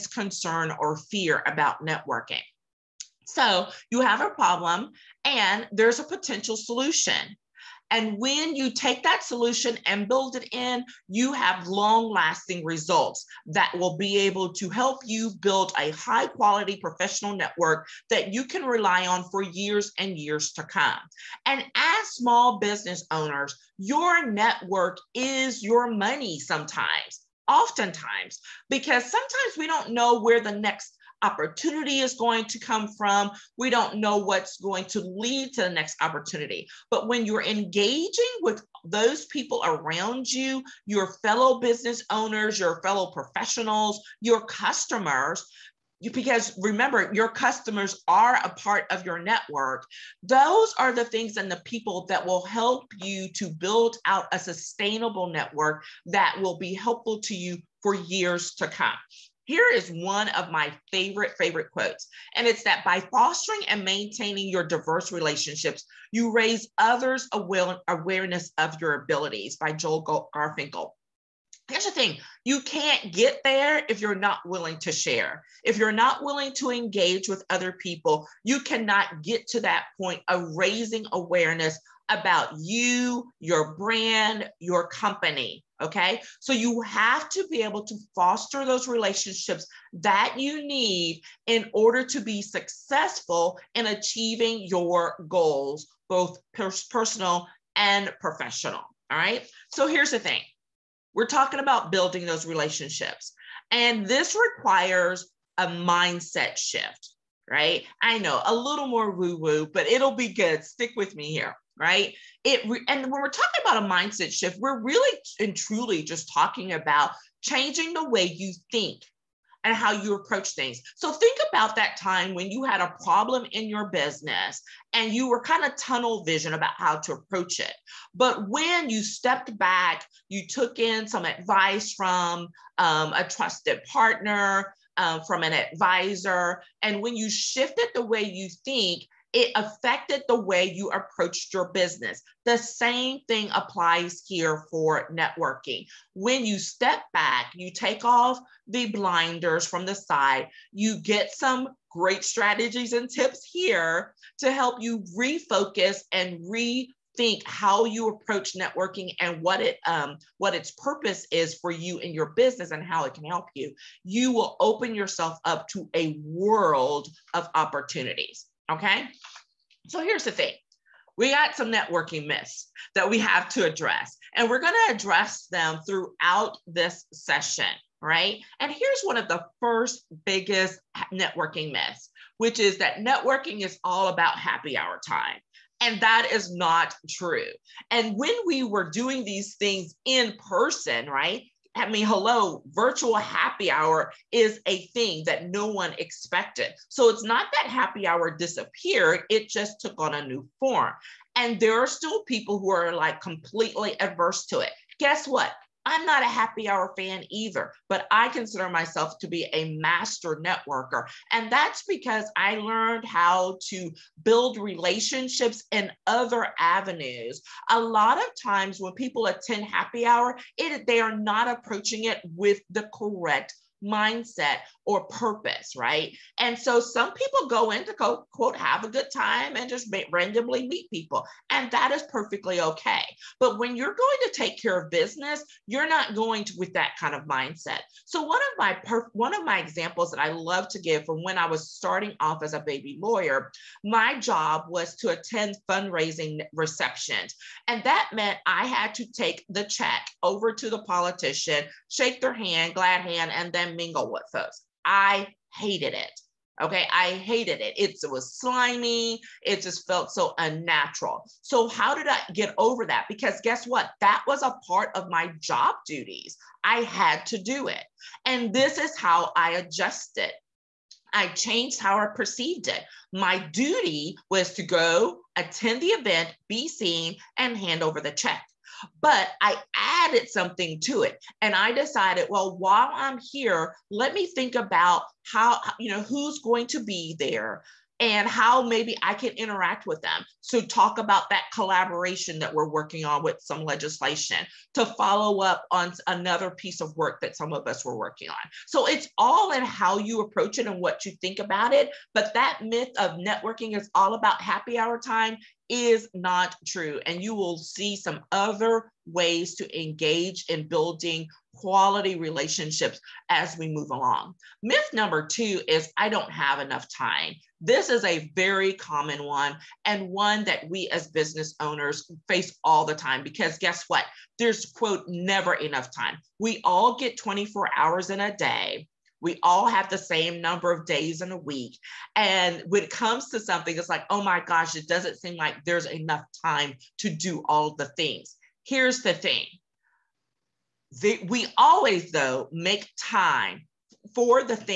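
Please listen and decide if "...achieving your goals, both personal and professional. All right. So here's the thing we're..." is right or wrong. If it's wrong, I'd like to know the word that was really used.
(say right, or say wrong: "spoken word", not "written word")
right.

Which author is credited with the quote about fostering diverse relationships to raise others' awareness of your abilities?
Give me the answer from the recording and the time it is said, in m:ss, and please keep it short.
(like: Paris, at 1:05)
Joel Garfinkel, at 1:09.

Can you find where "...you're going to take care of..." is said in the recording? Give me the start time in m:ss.
3:53.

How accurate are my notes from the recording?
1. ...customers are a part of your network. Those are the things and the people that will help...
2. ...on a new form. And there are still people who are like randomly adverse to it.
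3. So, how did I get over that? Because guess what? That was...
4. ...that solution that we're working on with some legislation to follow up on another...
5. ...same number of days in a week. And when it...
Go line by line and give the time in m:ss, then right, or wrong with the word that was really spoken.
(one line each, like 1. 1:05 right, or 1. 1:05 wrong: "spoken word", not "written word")
1. 0:47 right
2. 3:19 wrong: "completely", not "randomly"
3. 4:21 right
4. 4:51 wrong: "collaboration", not "solution"
5. 5:29 right.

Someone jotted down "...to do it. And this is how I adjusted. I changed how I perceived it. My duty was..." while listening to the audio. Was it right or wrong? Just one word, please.
right.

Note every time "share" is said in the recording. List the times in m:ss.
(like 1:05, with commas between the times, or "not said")
1:14.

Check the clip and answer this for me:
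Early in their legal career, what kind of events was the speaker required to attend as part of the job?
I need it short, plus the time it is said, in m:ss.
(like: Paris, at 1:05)
Fundraising receptions, at 4:05.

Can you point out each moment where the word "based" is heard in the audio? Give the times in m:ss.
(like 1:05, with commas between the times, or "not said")
not said.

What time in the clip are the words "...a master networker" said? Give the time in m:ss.
3:29.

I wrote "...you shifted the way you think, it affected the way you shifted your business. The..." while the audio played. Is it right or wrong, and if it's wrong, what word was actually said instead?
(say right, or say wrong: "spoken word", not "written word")
wrong: "approached", not "shifted".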